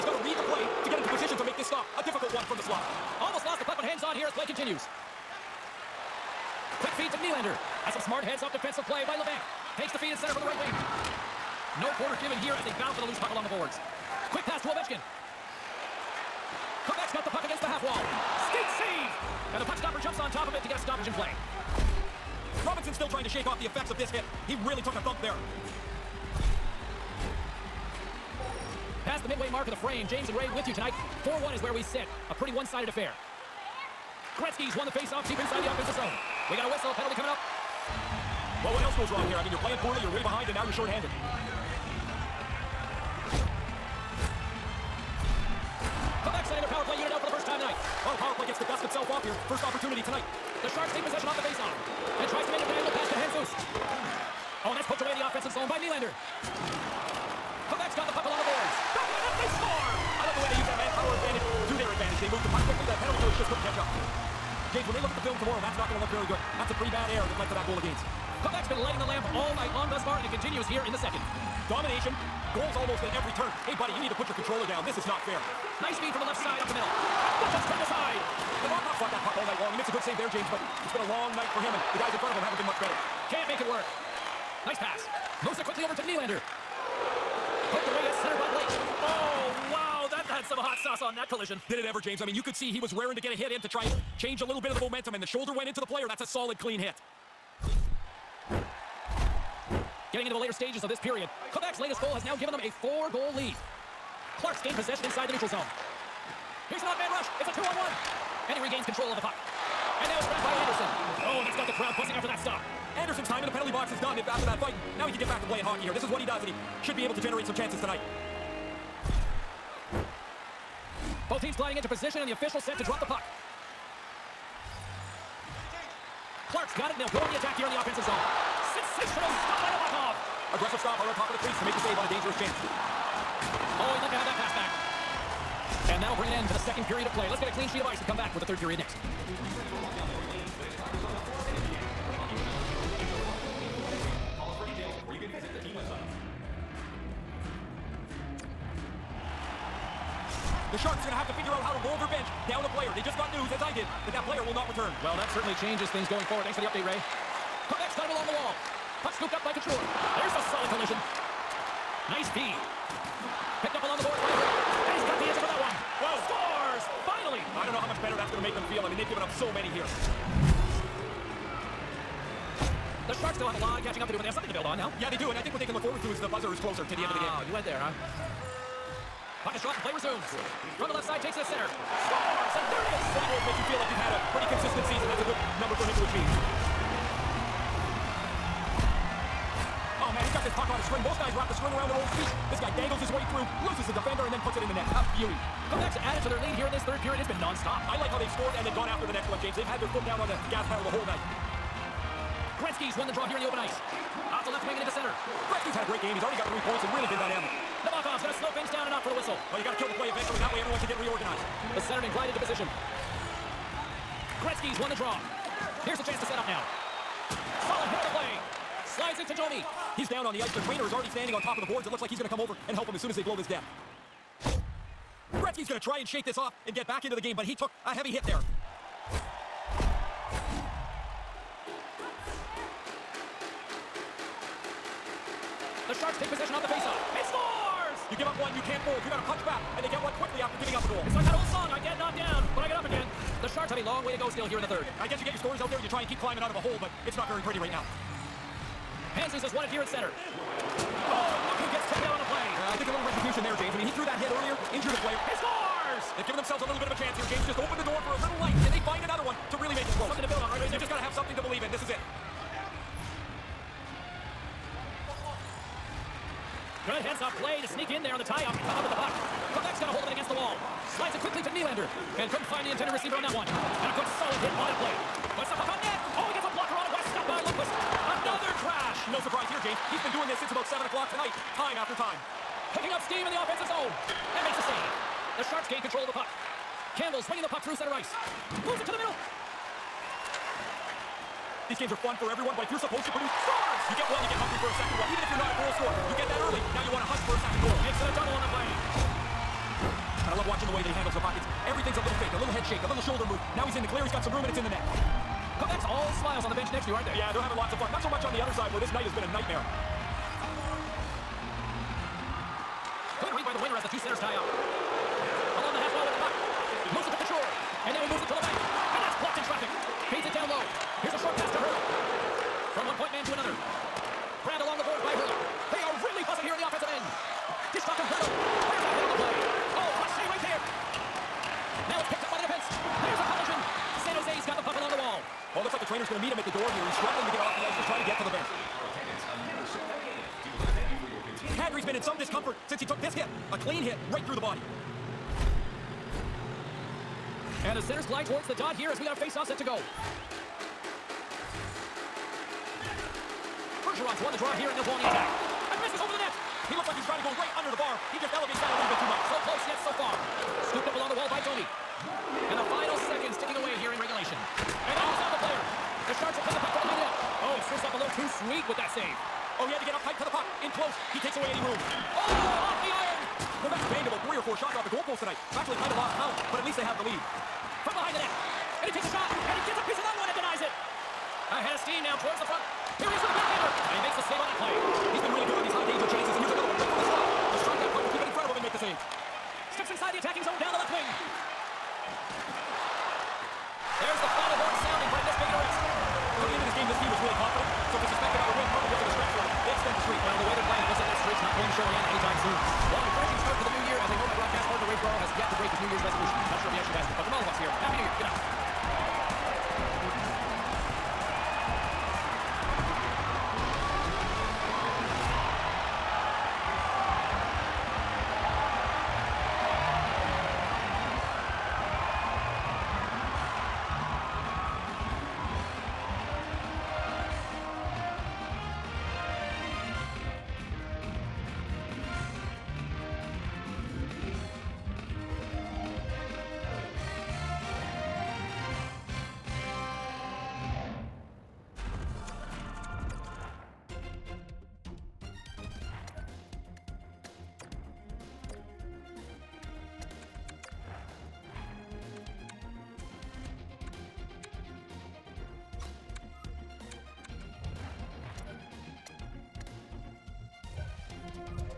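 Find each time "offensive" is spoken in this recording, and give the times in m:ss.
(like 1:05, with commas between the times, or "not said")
0:35, 0:55, 2:07, 4:43, 5:26.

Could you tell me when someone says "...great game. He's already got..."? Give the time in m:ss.
3:25.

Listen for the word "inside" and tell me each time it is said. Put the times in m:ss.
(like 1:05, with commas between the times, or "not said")
0:35, 1:45, 6:29.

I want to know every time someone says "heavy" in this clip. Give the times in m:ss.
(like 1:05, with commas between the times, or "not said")
3:47.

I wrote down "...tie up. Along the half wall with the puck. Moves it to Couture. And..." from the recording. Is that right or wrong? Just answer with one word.
right.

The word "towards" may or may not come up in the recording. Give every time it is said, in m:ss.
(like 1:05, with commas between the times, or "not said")
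5:48, 6:22.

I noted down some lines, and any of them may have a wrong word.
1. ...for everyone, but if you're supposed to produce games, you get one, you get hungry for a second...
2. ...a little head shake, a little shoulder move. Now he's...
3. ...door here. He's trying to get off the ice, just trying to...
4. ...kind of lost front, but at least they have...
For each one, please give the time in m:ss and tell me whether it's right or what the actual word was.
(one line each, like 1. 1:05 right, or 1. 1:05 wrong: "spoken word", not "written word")
1. 4:52 wrong: "scores", not "games"
2. 5:02 right
3. 5:36 wrong: "struggling", not "trying"
4. 6:15 wrong: "count", not "front".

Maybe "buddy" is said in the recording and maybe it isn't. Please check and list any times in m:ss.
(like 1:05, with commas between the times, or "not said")
1:13.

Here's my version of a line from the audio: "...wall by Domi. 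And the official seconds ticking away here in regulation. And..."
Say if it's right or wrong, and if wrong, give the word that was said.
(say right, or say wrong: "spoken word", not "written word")
wrong: "final", not "official".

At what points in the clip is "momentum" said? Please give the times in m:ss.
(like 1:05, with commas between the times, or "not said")
1:34.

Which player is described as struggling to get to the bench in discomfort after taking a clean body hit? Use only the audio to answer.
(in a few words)
Kadri.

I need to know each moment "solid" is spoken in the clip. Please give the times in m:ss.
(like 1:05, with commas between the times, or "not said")
1:36, 2:40, 3:37.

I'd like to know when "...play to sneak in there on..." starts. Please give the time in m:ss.
4:27.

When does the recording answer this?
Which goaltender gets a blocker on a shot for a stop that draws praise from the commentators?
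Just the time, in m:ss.
4:36.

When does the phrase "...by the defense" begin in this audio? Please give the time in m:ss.
5:32.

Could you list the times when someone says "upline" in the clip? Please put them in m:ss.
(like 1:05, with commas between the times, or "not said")
not said.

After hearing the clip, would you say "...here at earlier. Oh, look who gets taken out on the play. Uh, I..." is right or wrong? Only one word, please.
wrong.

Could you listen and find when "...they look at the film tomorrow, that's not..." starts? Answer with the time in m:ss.
1:04.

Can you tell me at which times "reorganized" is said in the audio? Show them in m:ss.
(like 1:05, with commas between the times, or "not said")
3:31.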